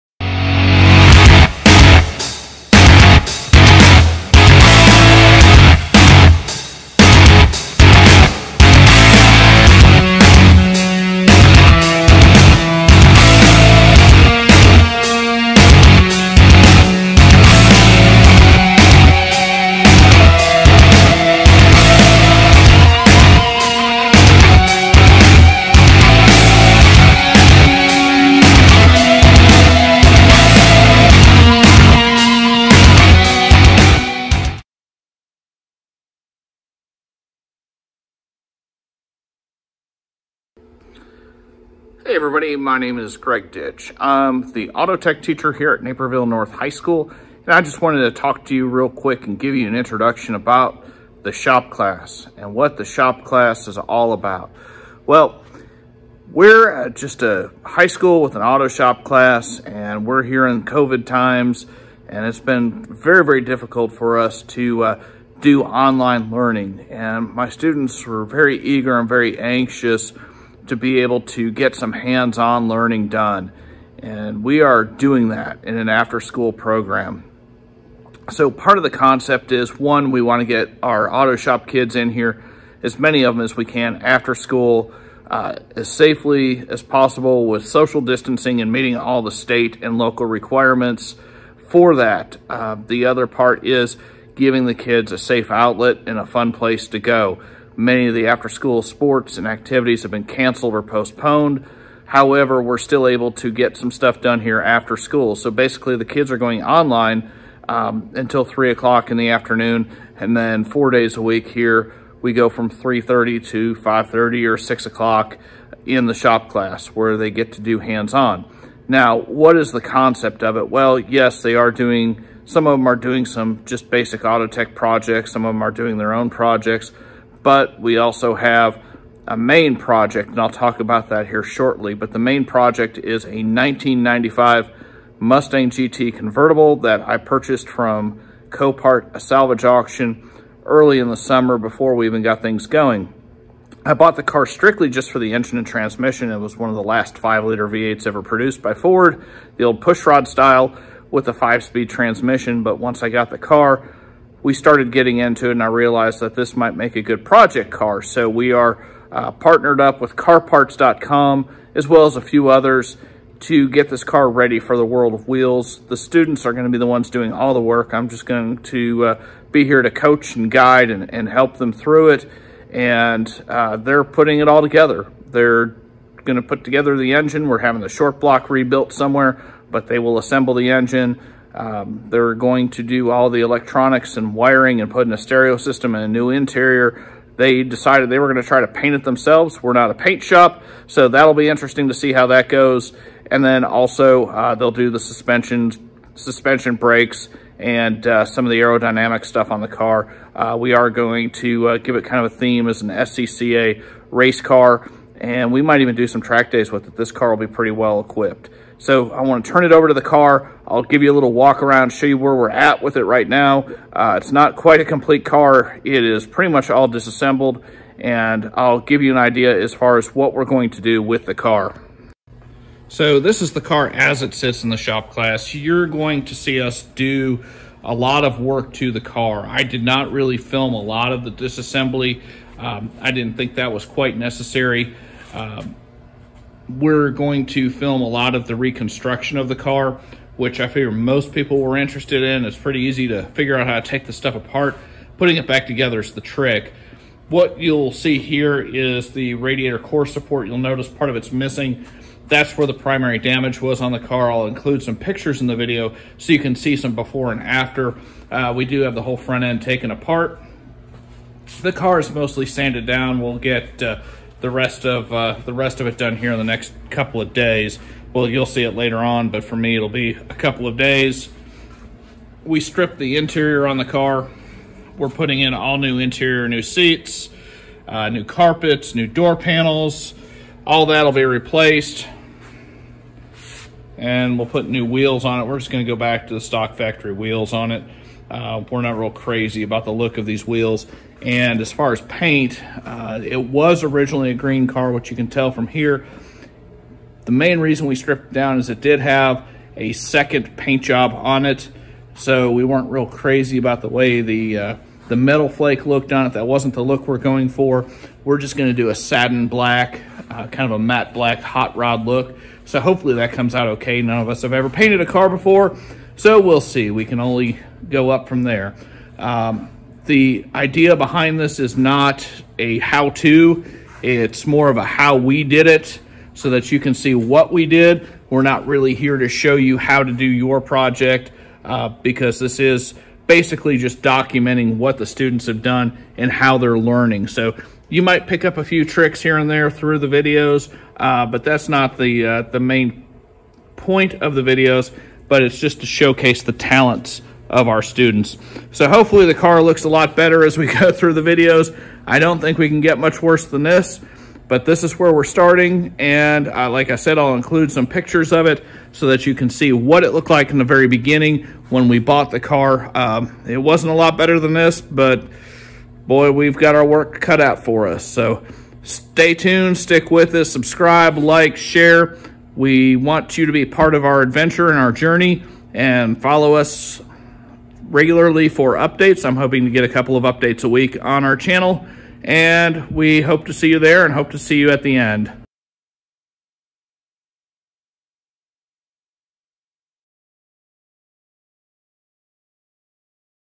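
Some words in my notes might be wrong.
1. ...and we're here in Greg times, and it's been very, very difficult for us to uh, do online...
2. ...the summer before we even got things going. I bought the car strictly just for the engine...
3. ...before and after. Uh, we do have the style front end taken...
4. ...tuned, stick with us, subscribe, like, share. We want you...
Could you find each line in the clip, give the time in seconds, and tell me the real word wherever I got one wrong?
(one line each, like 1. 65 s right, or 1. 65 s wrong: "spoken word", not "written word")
1. 59 s wrong: "COVID", not "Greg"
2. 141 s right
3. 256 s wrong: "whole", not "style"
4. 369 s right.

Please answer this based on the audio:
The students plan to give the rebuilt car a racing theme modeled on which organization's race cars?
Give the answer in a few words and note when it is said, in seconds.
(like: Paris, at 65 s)
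SCCA, at 202 s.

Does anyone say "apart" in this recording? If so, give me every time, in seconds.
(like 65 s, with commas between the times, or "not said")
244 s, 259 s.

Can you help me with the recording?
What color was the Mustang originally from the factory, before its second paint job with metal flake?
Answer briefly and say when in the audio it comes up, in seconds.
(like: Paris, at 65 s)
Green, at 294 s.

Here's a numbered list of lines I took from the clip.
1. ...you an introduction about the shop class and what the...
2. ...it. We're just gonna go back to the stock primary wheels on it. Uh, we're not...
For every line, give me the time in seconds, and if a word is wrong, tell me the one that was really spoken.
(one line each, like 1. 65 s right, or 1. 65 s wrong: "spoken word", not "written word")
1. 49 s right
2. 285 s wrong: "factory", not "primary".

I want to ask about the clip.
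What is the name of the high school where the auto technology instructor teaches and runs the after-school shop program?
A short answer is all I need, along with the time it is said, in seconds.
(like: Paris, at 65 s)
Naperville North High School, at 45 s.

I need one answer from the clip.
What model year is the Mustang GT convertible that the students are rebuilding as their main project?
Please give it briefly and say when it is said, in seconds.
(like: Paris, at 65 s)
1995, at 133 s.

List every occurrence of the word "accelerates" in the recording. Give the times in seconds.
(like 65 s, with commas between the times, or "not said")
not said.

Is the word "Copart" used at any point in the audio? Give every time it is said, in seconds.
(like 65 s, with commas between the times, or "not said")
138 s.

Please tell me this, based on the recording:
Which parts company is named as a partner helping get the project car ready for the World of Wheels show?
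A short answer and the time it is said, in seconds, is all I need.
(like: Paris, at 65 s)
carparts.com, at 160 s.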